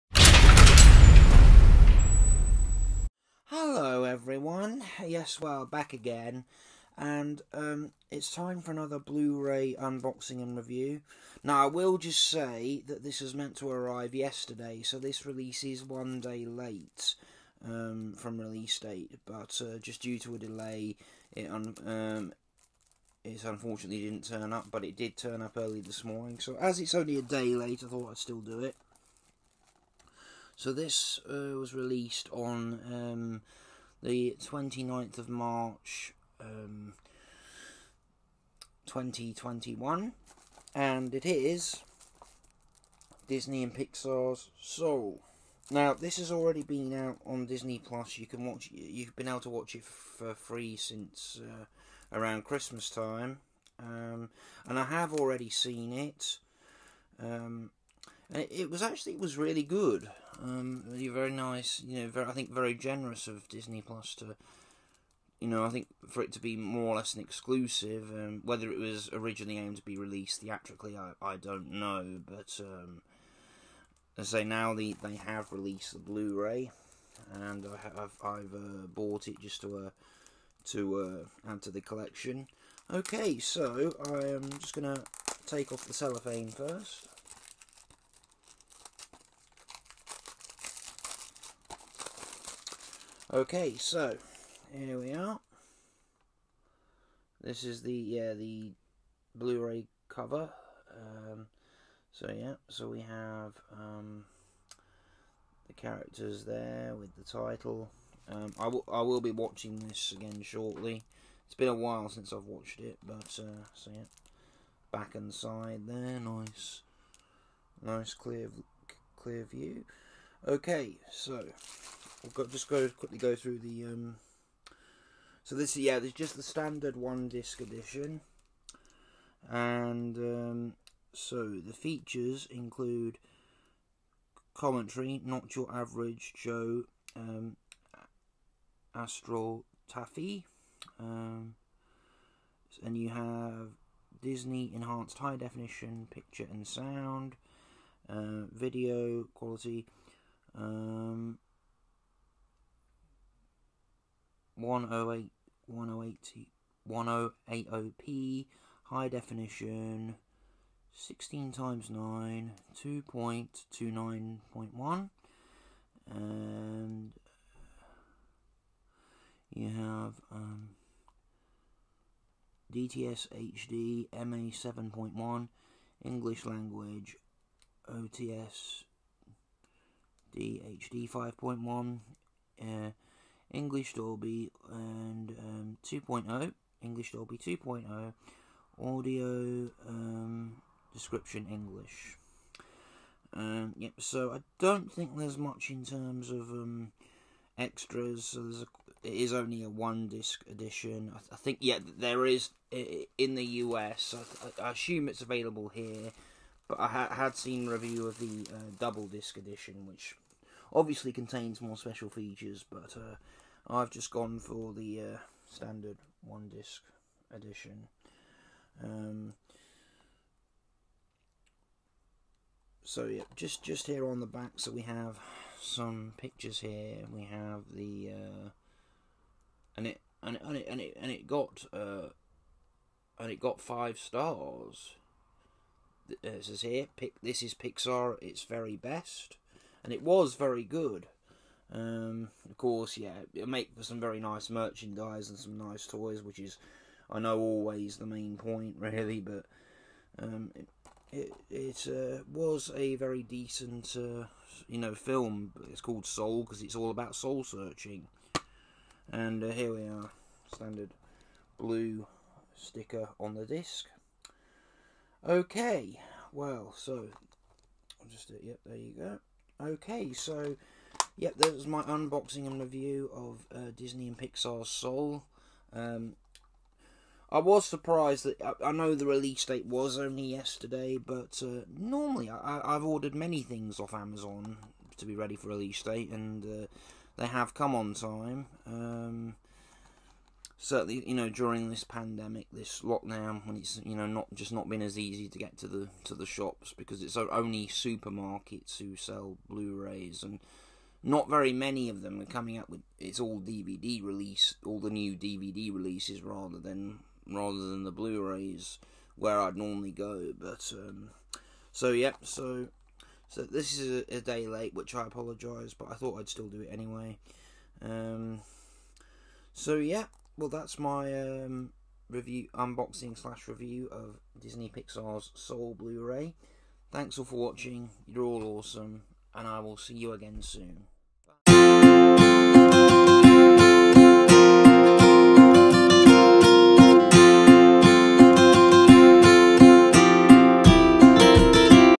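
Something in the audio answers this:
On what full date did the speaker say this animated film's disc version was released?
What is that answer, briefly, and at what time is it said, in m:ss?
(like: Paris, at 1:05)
29 March 2021, at 0:34.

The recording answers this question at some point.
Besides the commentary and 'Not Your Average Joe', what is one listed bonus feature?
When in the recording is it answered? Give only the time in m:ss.
2:18.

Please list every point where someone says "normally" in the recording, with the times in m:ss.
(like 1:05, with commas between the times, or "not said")
4:41, 5:09.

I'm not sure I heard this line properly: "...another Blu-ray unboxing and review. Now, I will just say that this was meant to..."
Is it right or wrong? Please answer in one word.
right.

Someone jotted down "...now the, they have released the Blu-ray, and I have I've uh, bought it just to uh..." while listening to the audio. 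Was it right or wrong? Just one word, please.
right.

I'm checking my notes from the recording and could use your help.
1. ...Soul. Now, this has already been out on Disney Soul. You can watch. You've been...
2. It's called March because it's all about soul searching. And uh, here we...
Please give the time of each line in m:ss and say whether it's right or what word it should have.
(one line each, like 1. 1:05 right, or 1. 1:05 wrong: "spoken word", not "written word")
1. 0:44 wrong: "Plus", not "Soul"
2. 4:15 wrong: "Soul", not "March".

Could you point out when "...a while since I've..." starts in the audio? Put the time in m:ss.
1:51.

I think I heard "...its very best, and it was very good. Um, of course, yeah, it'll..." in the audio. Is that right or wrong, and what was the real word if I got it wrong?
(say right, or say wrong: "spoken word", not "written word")
right.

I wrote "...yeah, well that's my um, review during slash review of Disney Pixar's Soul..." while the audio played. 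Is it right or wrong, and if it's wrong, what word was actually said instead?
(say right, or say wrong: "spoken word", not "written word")
wrong: "unboxing", not "during".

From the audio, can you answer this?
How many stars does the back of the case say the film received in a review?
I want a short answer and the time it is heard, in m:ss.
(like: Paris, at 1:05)
5, at 3:53.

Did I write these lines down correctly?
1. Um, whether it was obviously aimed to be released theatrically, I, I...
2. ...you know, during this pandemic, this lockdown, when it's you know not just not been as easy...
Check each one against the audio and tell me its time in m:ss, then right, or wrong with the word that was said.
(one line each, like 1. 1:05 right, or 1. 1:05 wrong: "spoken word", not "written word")
1. 1:08 wrong: "originally", not "obviously"
2. 4:51 right.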